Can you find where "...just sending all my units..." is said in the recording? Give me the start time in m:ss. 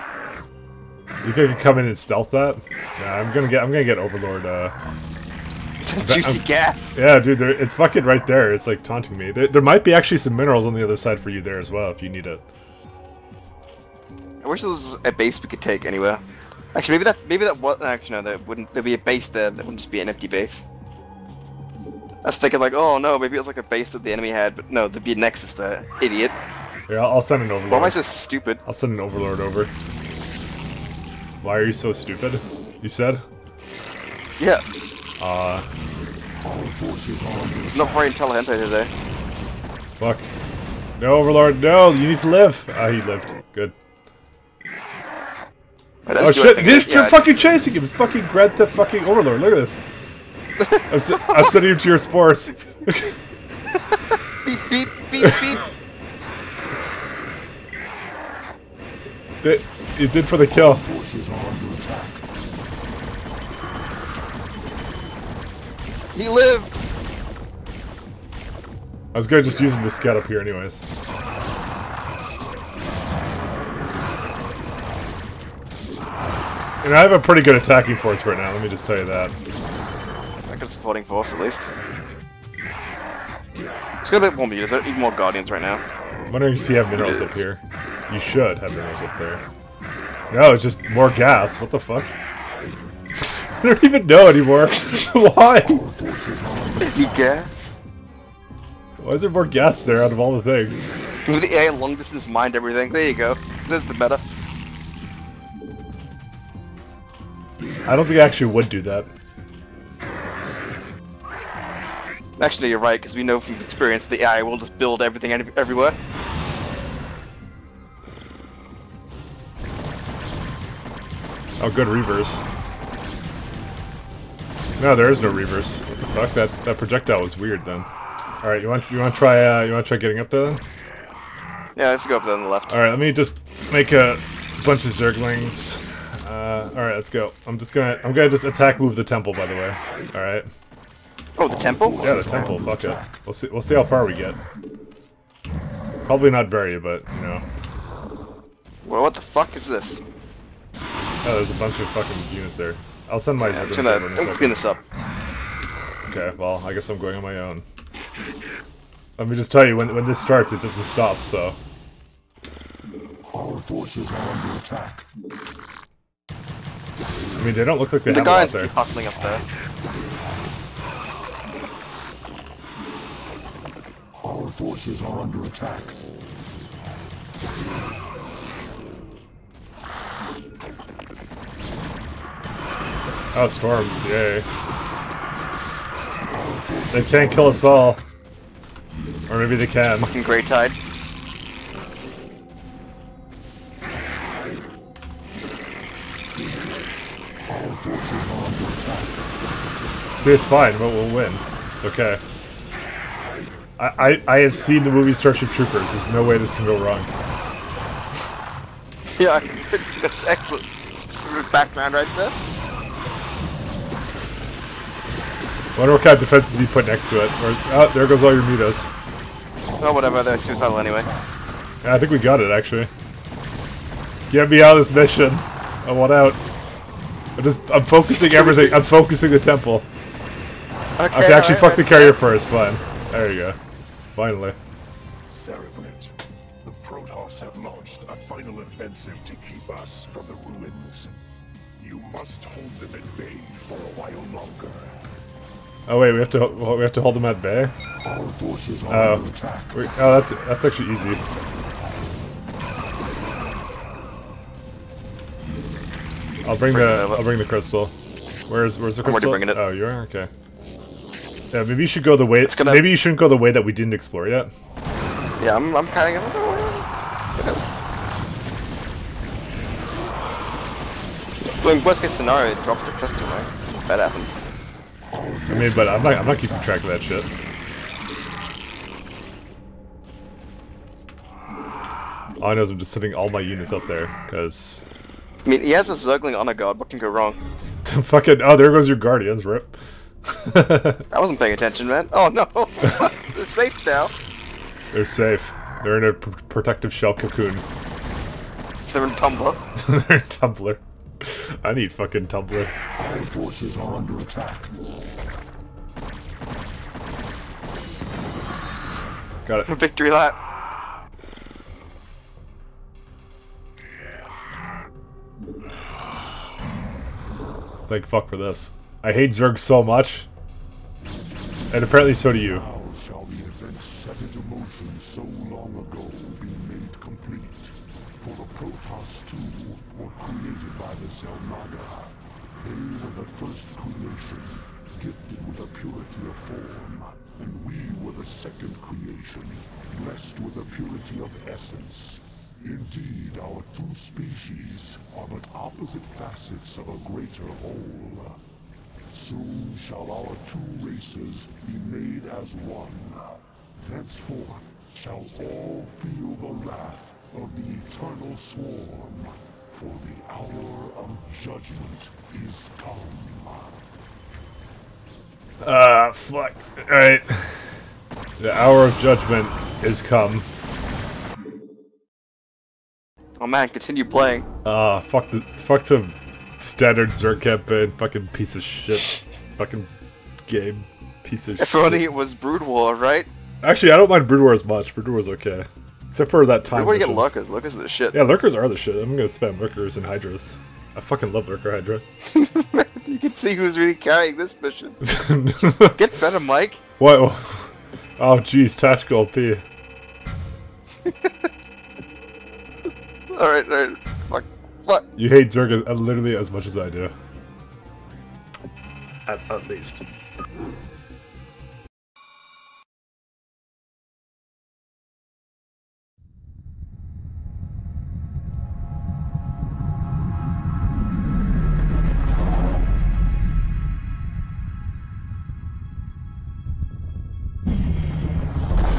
4:42.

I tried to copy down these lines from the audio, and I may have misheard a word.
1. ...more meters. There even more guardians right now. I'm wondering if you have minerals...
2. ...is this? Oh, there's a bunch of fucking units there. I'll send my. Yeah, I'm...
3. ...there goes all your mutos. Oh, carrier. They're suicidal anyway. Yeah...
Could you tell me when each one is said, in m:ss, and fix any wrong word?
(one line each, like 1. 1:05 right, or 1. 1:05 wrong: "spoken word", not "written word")
1. 1:24 right
2. 2:29 right
3. 3:37 wrong: "whatever", not "carrier".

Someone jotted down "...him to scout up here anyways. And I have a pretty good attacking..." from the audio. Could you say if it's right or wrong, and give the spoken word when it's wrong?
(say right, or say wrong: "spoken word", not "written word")
right.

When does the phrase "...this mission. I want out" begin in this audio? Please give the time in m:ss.
3:44.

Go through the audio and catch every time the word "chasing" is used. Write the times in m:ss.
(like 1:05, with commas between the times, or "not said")
0:47.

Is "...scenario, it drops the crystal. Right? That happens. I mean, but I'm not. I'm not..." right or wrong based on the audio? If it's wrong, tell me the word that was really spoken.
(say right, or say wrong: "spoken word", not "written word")
right.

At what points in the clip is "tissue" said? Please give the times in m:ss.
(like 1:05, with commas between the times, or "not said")
not said.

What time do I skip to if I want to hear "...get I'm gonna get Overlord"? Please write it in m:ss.
0:03.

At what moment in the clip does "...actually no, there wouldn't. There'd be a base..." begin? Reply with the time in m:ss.
0:17.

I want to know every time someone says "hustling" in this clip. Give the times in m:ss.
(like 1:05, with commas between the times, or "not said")
2:48.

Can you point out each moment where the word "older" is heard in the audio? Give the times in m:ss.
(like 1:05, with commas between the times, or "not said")
not said.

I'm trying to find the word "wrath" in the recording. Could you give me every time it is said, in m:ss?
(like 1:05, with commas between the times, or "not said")
5:56.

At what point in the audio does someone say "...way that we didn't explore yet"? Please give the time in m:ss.
4:23.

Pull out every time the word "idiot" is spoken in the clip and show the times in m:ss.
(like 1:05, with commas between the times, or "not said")
0:26.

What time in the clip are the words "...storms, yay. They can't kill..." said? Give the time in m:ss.
3:03.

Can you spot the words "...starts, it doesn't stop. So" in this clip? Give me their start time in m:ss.
2:40.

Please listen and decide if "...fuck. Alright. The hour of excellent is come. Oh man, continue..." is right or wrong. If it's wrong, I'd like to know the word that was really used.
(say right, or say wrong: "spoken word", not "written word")
wrong: "judgment", not "excellent".